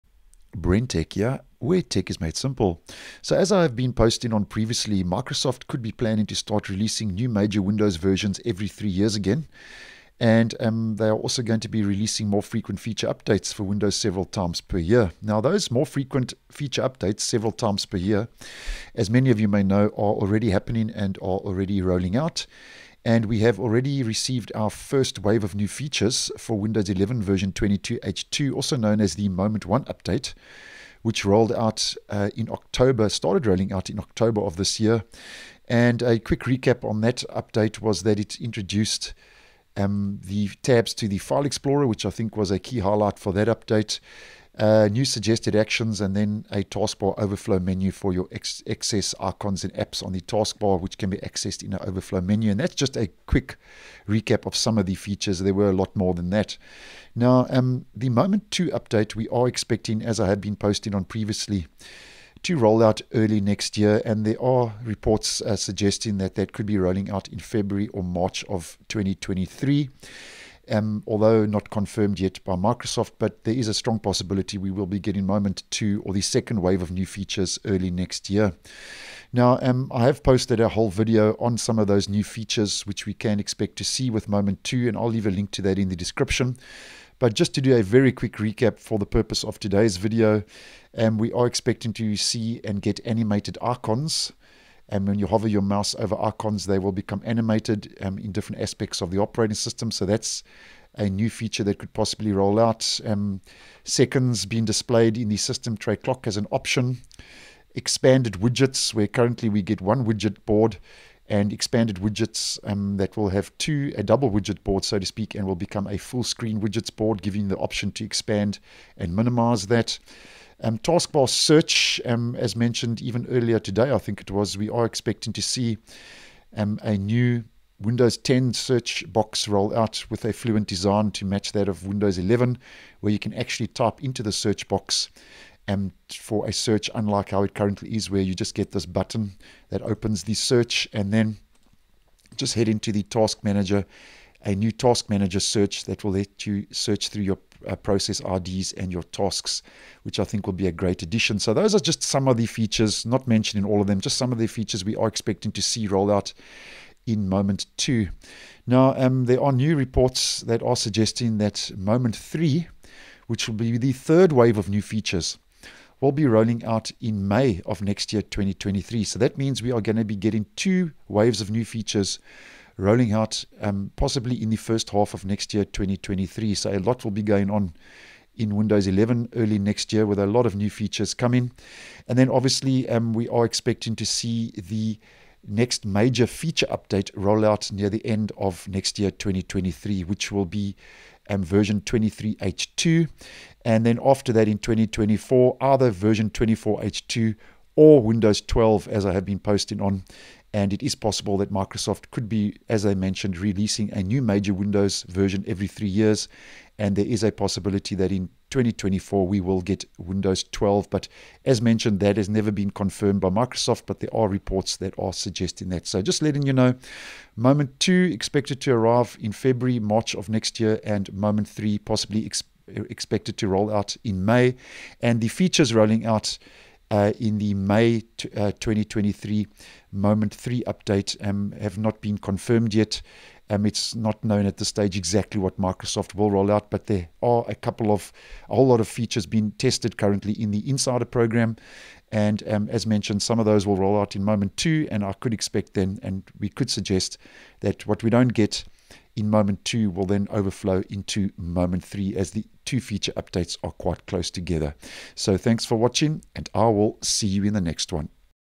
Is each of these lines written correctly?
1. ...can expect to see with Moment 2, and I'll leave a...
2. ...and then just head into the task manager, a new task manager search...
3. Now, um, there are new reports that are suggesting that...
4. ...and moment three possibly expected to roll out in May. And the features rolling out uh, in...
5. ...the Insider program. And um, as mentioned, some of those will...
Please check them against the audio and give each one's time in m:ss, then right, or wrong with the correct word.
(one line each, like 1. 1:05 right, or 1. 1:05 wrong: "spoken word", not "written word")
1. 1:23 right
2. 2:20 right
3. 2:38 right
4. 3:40 right
5. 4:00 right.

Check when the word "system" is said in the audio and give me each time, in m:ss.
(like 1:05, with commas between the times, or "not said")
1:39, 1:45.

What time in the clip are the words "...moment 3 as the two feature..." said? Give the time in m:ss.
4:11.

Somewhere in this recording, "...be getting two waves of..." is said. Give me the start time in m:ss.
2:50.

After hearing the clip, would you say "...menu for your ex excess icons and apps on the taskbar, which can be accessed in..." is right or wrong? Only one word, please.
right.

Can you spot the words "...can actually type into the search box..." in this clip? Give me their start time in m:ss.
2:13.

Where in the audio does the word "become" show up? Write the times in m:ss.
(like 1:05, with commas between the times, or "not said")
1:36, 1:55.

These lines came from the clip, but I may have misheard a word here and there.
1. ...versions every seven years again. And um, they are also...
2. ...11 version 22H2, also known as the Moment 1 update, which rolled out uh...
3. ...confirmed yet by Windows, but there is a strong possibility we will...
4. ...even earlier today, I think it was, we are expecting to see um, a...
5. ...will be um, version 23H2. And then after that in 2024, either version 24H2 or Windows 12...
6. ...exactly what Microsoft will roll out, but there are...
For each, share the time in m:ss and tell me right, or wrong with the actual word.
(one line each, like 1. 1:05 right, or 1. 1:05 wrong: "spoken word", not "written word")
1. 0:07 wrong: "three", not "seven"
2. 0:26 right
3. 1:11 wrong: "Microsoft", not "Windows"
4. 2:03 right
5. 3:10 right
6. 3:54 right.